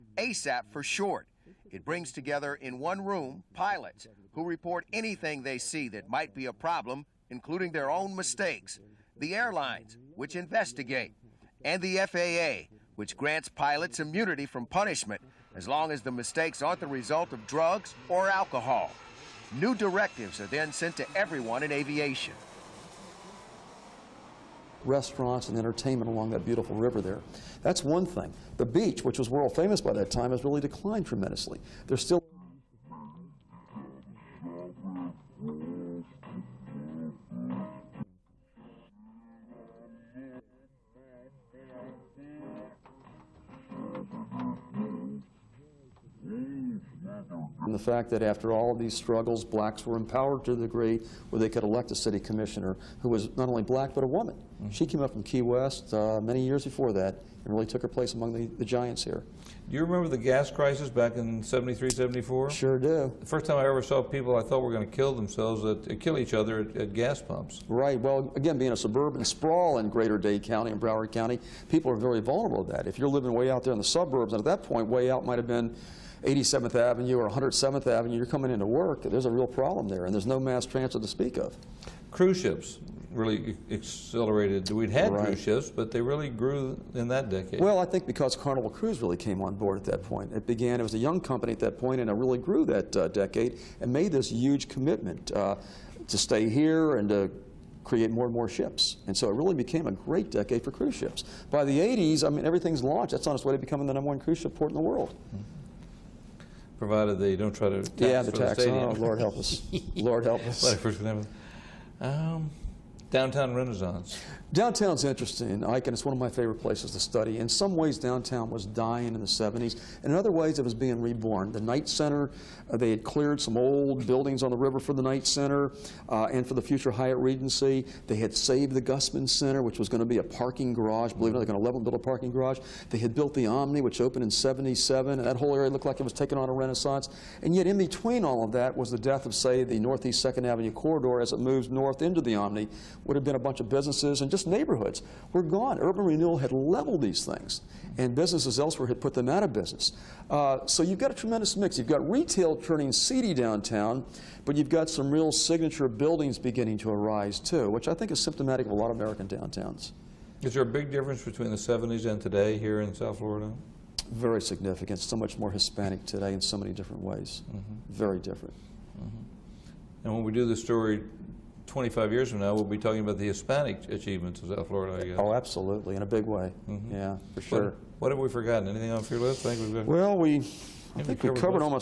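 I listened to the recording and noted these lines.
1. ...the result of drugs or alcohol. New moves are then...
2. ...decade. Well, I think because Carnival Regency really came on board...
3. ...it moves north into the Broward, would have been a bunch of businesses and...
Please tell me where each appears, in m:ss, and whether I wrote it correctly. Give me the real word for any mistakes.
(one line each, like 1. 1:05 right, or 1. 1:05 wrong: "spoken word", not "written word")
1. 0:16 wrong: "directives", not "moves"
2. 1:27 wrong: "Cruise", not "Regency"
3. 2:21 wrong: "Omni", not "Broward".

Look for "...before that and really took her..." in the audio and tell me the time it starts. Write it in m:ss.
0:56.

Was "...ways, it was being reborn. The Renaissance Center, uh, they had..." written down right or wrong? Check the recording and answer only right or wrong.
wrong.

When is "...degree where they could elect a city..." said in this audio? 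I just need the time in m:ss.
0:50.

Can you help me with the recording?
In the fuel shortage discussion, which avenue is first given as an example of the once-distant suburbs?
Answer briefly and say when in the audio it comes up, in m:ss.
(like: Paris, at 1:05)
87th Avenue, at 1:16.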